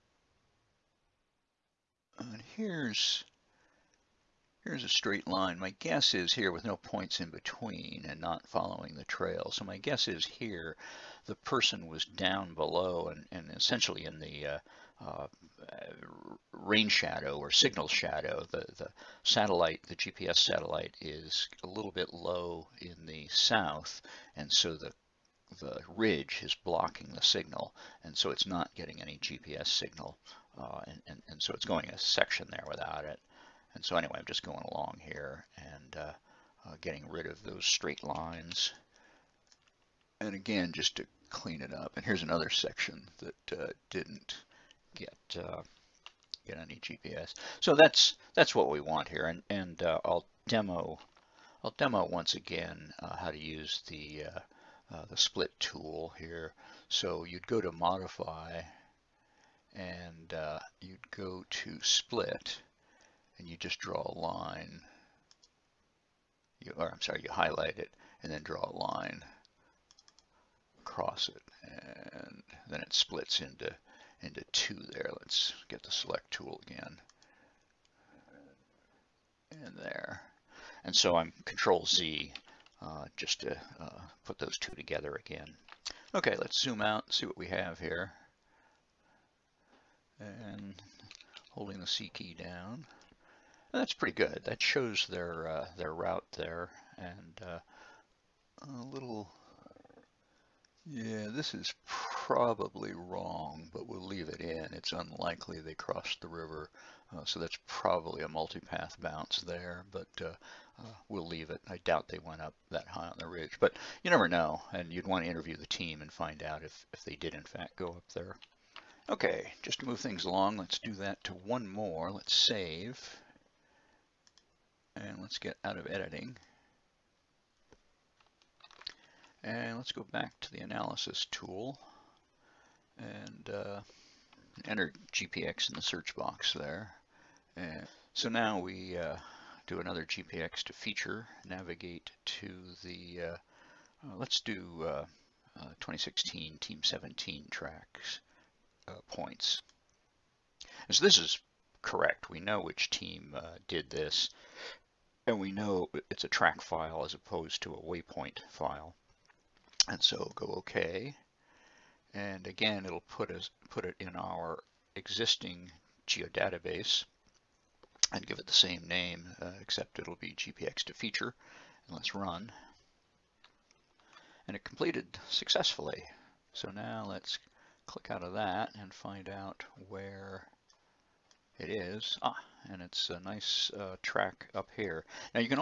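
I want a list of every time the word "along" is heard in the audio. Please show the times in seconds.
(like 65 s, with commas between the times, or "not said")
34 s, 120 s.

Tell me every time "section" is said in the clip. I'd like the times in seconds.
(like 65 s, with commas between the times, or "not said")
31 s, 42 s.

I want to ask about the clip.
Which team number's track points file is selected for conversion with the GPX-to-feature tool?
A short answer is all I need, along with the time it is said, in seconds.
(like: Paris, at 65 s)
17, at 146 s.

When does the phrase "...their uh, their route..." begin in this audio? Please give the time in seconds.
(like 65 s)
95 s.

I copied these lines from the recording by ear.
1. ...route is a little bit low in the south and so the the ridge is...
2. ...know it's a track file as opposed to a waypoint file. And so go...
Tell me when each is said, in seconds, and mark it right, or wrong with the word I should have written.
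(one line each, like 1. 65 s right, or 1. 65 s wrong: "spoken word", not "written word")
1. 20 s wrong: "satellite", not "route"
2. 155 s right.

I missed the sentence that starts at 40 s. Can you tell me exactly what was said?
And again, just to clean it up.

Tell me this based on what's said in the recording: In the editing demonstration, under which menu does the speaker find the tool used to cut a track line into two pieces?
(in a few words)
Modify.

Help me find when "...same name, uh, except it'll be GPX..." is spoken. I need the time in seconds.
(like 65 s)
168 s.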